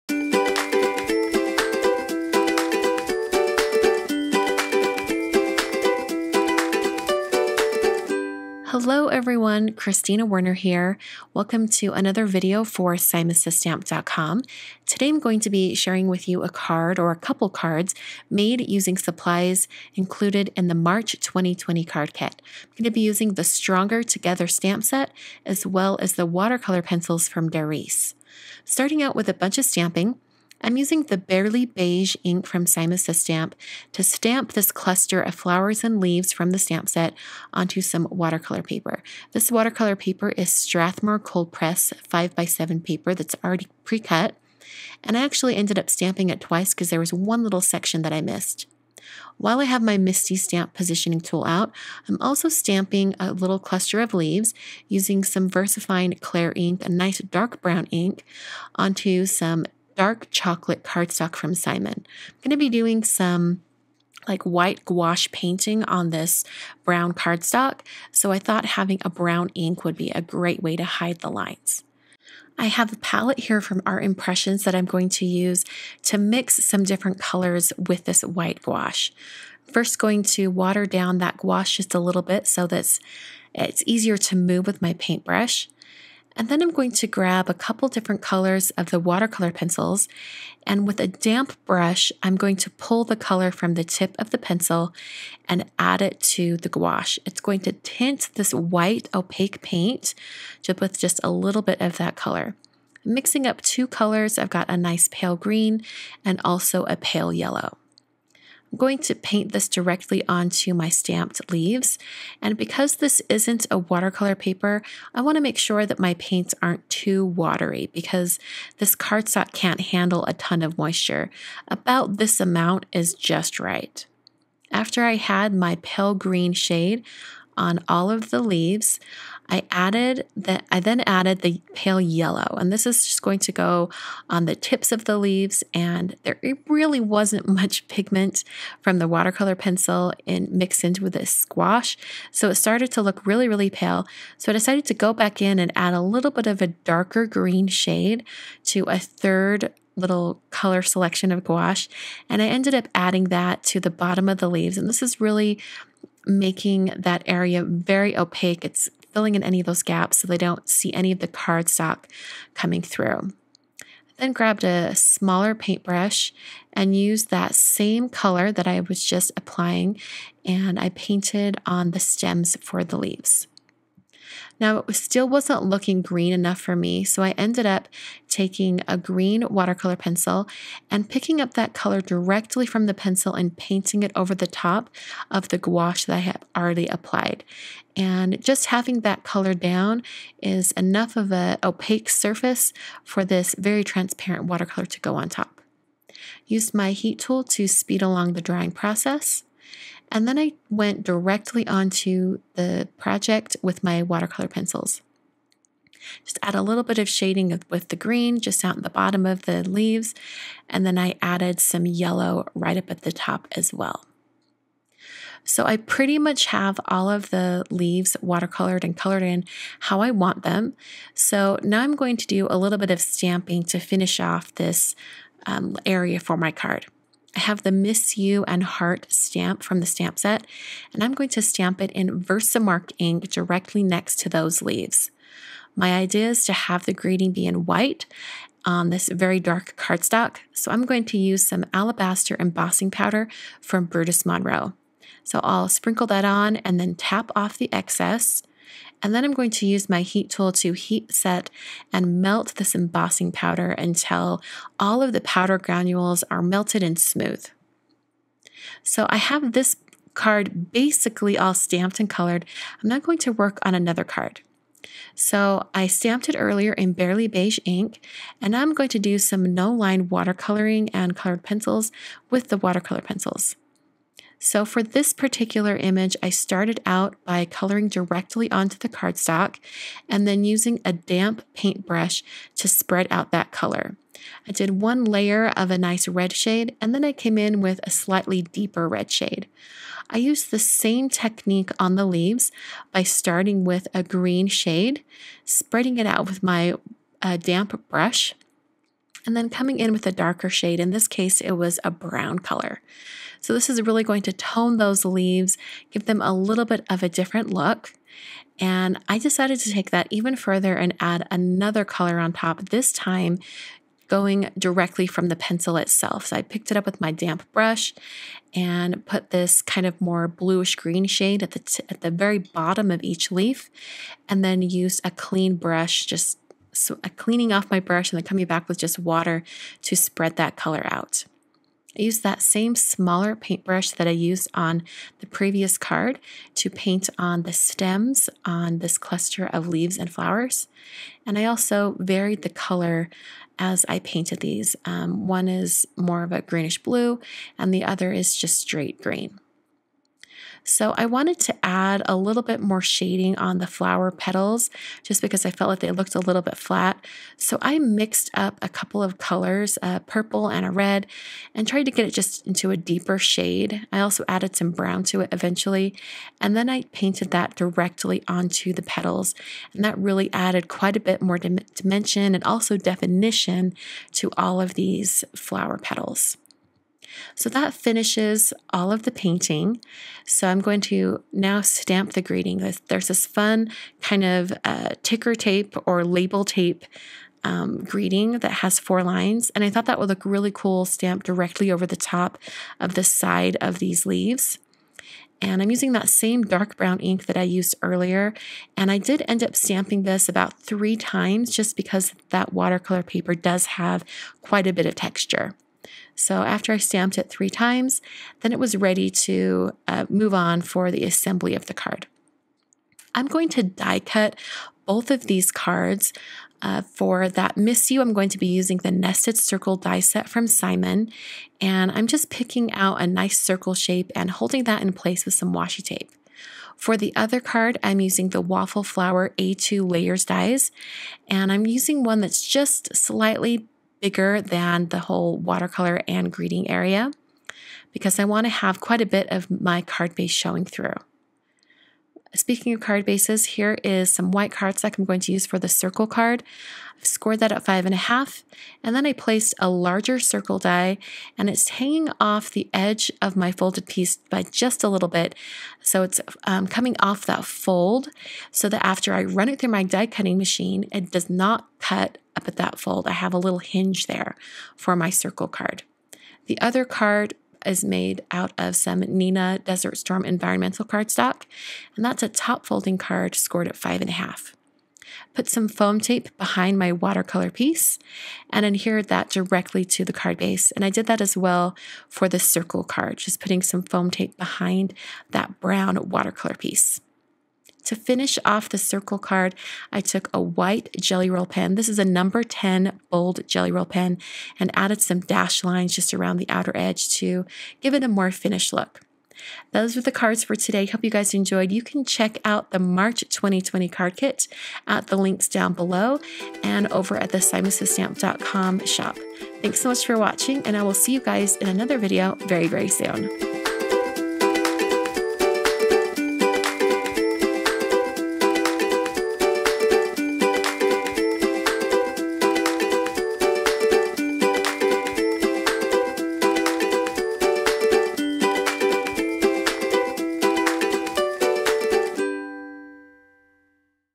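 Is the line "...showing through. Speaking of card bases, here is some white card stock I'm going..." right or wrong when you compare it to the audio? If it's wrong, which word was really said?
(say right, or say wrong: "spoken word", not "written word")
right.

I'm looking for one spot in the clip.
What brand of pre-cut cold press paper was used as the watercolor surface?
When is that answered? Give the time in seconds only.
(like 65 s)
40 s.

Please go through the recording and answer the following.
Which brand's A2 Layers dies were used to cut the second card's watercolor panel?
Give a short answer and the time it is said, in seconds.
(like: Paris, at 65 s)
Waffle Flower, at 428 s.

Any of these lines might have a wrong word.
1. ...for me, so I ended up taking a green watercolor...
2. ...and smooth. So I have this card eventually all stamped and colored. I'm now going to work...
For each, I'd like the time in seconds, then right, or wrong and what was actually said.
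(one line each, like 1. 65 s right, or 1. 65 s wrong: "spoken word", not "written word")
1. 176 s right
2. 256 s wrong: "basically", not "eventually".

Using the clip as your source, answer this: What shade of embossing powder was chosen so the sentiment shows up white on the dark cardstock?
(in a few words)
alabaster.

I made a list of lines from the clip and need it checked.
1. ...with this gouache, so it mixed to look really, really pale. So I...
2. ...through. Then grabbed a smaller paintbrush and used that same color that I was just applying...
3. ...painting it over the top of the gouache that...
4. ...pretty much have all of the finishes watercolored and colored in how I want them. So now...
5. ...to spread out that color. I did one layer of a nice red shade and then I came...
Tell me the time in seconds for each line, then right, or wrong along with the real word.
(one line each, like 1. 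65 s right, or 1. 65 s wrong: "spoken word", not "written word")
1. 141 s wrong: "started", not "mixed"
2. 162 s right
3. 183 s right
4. 215 s wrong: "leaves", not "finishes"
5. 282 s right.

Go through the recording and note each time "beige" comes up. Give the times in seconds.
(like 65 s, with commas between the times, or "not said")
31 s, 267 s.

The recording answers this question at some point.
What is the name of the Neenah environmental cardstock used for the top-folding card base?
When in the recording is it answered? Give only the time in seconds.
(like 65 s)
469 s.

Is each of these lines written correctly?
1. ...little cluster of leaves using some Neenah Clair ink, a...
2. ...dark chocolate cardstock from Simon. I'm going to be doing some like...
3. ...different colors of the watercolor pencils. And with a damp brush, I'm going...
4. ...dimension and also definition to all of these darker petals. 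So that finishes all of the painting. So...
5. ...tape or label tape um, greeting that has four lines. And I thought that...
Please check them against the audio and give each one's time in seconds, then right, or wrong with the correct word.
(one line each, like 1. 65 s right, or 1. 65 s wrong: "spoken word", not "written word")
1. 53 s wrong: "VersaFine", not "Neenah"
2. 59 s right
3. 87 s right
4. 371 s wrong: "flower", not "darker"
5. 385 s right.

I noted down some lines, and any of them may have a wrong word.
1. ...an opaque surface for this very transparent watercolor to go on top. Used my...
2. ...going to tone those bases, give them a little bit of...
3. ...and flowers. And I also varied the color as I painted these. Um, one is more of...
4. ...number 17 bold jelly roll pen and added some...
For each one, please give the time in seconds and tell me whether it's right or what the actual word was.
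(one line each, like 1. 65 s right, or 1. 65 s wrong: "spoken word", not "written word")
1. 191 s right
2. 304 s wrong: "leaves", not "bases"
3. 339 s right
4. 492 s wrong: "10", not "17".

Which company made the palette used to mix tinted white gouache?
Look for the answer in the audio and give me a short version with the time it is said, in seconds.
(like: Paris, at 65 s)
Art Impressions, at 73 s.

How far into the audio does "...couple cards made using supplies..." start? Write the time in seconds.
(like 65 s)
17 s.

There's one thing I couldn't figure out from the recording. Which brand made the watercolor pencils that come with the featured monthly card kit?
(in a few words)
Darice.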